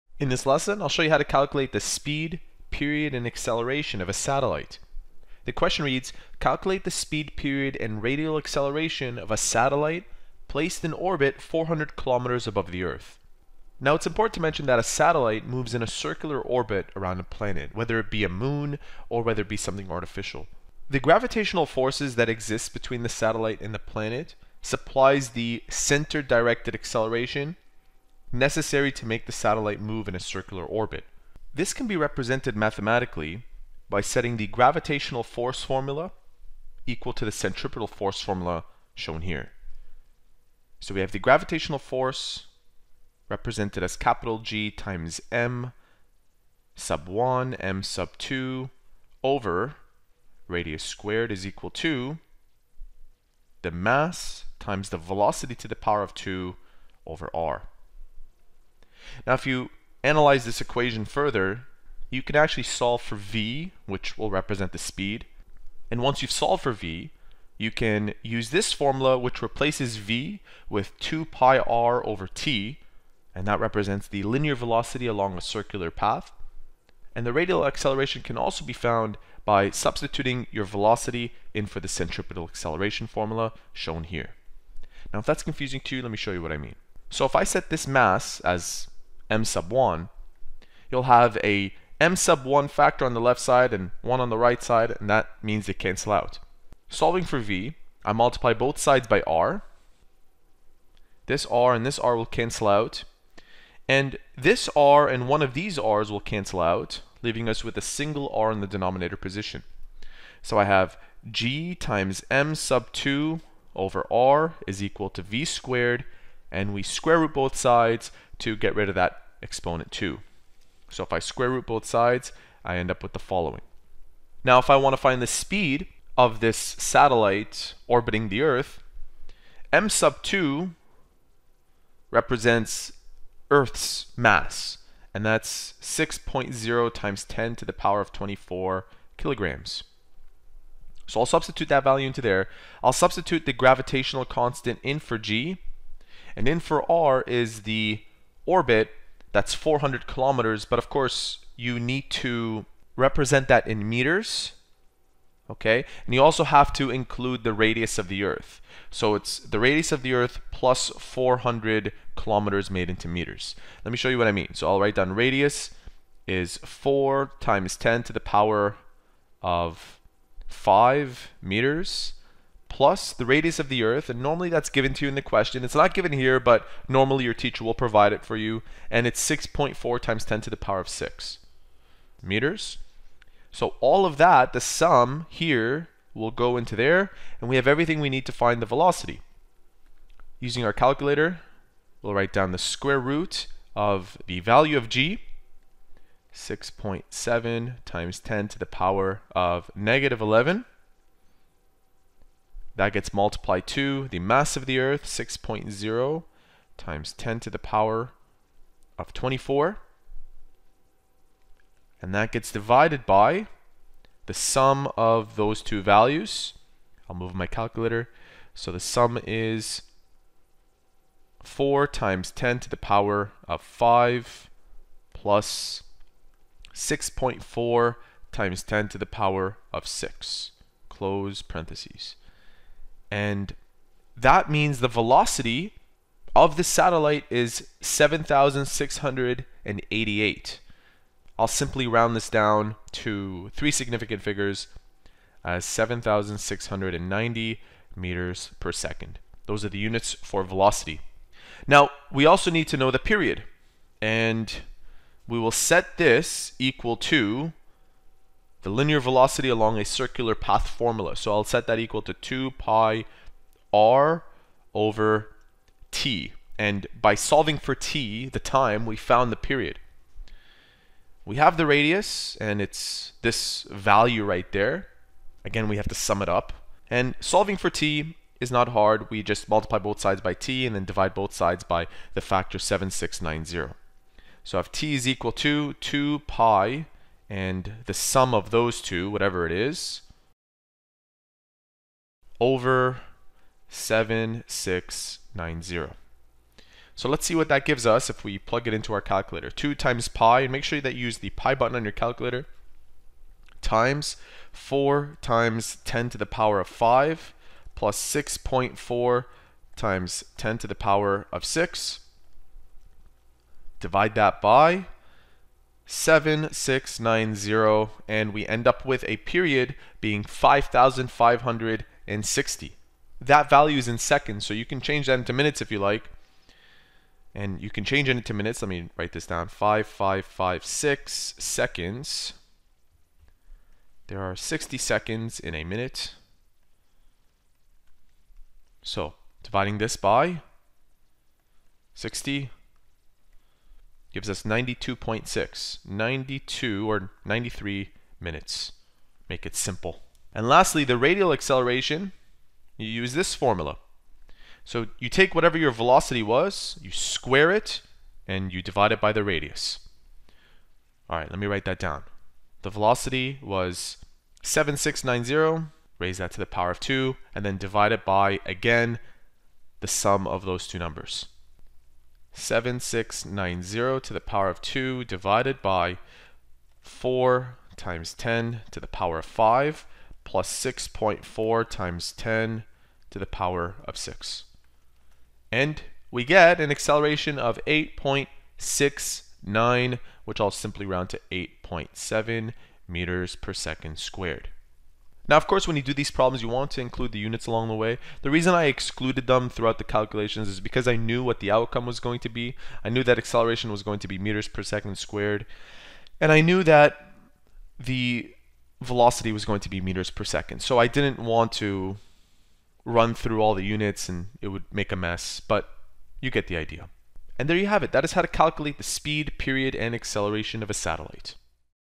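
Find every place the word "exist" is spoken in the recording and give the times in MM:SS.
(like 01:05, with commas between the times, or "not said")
00:22.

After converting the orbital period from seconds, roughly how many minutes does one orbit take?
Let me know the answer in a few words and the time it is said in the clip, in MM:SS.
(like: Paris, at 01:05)
92.6 minutes, at 05:44.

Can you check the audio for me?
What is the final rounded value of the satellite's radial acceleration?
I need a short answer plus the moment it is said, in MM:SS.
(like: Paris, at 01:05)
8.7 m/s², at 06:31.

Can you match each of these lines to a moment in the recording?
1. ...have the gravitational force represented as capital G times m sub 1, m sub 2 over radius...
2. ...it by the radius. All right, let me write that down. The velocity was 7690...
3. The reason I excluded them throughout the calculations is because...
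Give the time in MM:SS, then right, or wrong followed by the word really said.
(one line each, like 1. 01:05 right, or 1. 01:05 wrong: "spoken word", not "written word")
1. 00:41 right
2. 05:58 right
3. 06:38 right.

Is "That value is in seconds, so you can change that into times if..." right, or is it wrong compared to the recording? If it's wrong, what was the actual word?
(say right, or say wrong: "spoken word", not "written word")
wrong: "minutes", not "times".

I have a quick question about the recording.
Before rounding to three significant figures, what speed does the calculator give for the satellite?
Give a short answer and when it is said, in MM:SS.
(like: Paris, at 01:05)
7,688, at 03:57.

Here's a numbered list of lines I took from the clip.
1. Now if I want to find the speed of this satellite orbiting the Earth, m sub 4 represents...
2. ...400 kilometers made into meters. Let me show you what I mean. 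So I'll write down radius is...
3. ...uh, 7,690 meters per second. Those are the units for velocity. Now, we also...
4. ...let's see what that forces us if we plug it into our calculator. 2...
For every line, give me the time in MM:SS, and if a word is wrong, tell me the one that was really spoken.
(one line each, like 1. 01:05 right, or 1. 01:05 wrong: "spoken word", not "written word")
1. 02:04 wrong: "2", not "4"
2. 02:40 right
3. 04:05 right
4. 04:57 wrong: "gives", not "forces".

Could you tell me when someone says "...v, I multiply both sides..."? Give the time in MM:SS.
01:37.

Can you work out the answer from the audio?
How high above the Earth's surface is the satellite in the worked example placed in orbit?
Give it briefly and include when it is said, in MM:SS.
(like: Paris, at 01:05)
400 kilometers, at 00:11.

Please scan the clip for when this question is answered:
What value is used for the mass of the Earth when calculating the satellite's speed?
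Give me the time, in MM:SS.
02:15.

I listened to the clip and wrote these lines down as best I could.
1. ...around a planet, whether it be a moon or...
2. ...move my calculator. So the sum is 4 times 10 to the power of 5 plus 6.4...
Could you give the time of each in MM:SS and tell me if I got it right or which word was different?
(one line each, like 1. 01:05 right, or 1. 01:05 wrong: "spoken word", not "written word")
1. 00:16 right
2. 03:37 right.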